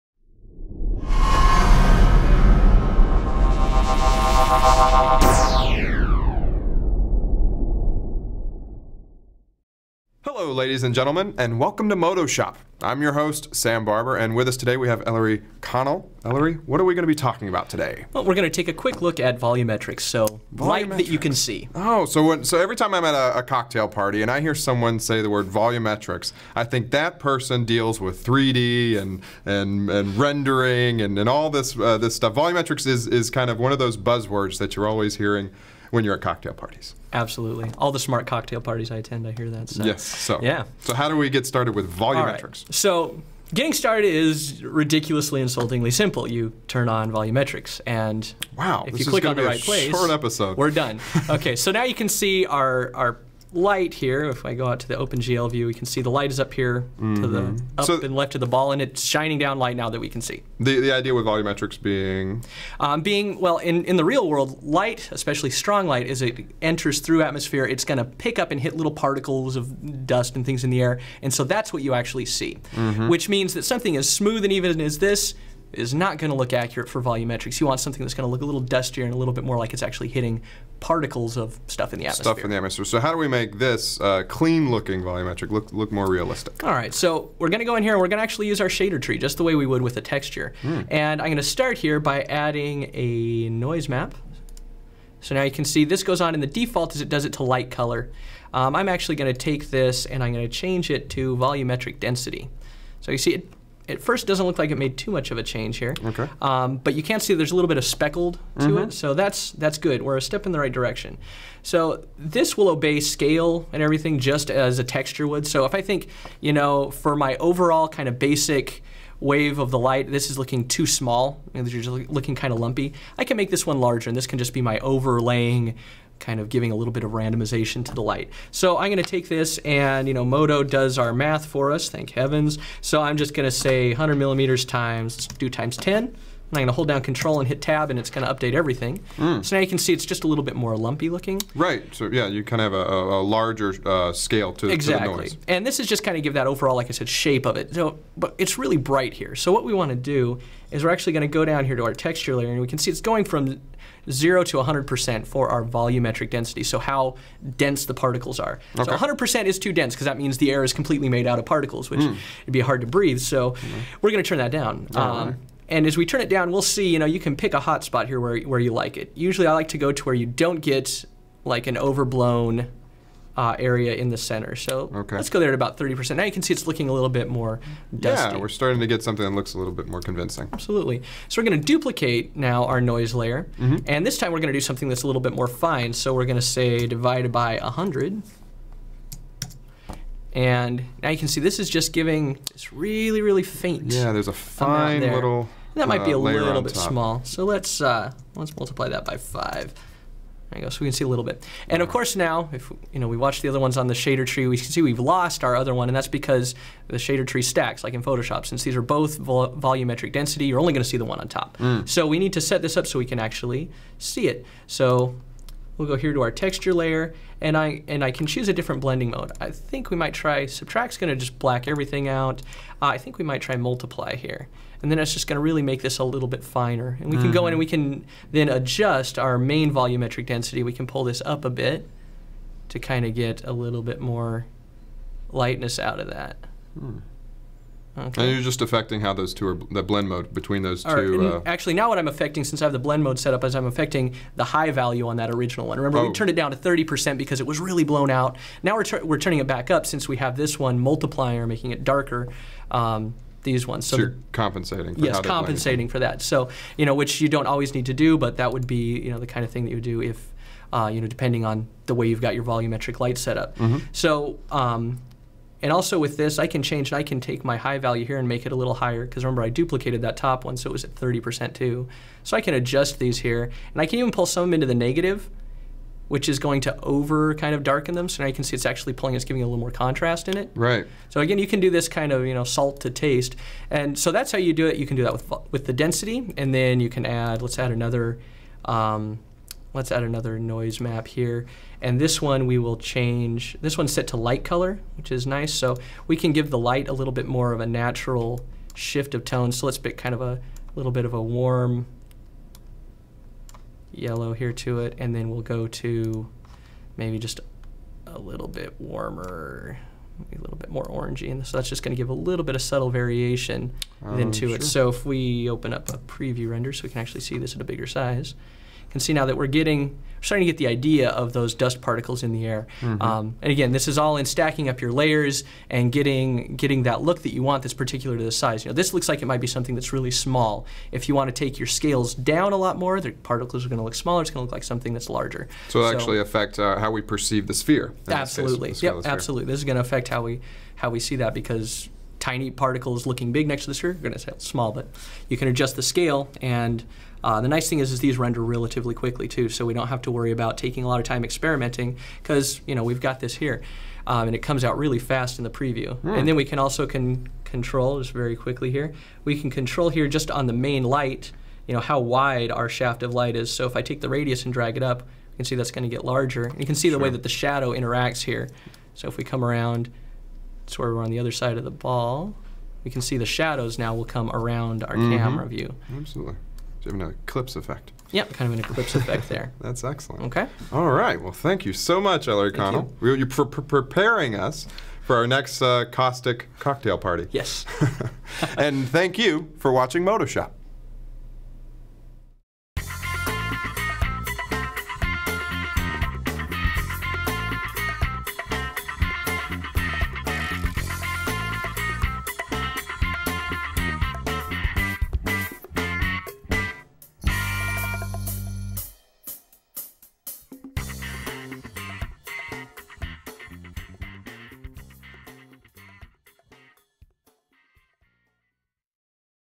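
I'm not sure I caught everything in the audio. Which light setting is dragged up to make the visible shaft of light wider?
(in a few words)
radius.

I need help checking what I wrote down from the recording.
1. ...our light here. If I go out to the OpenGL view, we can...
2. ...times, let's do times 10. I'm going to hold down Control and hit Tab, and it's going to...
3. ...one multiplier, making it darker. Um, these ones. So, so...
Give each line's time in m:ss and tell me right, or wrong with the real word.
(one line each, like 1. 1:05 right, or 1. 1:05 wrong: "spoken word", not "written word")
1. 0:52 right
2. 2:14 right
3. 4:10 right.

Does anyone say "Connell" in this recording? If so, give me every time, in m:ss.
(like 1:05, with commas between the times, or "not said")
0:15, 6:22.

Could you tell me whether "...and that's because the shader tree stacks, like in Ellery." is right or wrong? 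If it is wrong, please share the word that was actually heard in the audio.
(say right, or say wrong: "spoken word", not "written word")
wrong: "Photoshop", not "Ellery".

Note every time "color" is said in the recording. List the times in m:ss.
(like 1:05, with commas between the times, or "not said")
1:37, 4:54.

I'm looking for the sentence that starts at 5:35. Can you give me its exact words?
So it so, actually affect uh, how we perceive the sphere.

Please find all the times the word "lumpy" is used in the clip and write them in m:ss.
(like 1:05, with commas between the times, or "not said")
2:02, 2:20.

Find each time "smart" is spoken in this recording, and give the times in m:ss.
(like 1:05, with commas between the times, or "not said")
0:37.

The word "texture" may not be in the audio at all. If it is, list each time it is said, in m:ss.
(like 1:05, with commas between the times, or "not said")
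1:30, 1:54, 2:31, 3:36.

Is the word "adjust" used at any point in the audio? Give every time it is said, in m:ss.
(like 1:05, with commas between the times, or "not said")
3:48, 4:32, 5:45.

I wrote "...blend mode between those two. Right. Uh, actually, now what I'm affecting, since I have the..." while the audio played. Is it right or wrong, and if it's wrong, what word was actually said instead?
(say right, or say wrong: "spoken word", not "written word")
right.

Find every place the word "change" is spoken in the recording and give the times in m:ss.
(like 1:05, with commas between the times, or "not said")
1:40, 1:45, 4:26, 4:52.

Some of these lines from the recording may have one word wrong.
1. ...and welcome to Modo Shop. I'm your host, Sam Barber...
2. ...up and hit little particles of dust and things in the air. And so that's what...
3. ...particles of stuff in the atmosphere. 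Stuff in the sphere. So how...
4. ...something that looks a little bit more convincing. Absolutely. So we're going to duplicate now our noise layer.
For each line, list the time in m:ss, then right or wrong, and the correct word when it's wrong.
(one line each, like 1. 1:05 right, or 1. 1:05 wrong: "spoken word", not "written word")
1. 0:11 right
2. 1:08 right
3. 1:20 wrong: "atmosphere", not "sphere"
4. 2:59 right.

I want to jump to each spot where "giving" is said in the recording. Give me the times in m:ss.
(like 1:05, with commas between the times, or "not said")
2:06, 3:11, 4:39.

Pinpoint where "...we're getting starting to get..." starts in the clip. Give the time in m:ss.
5:19.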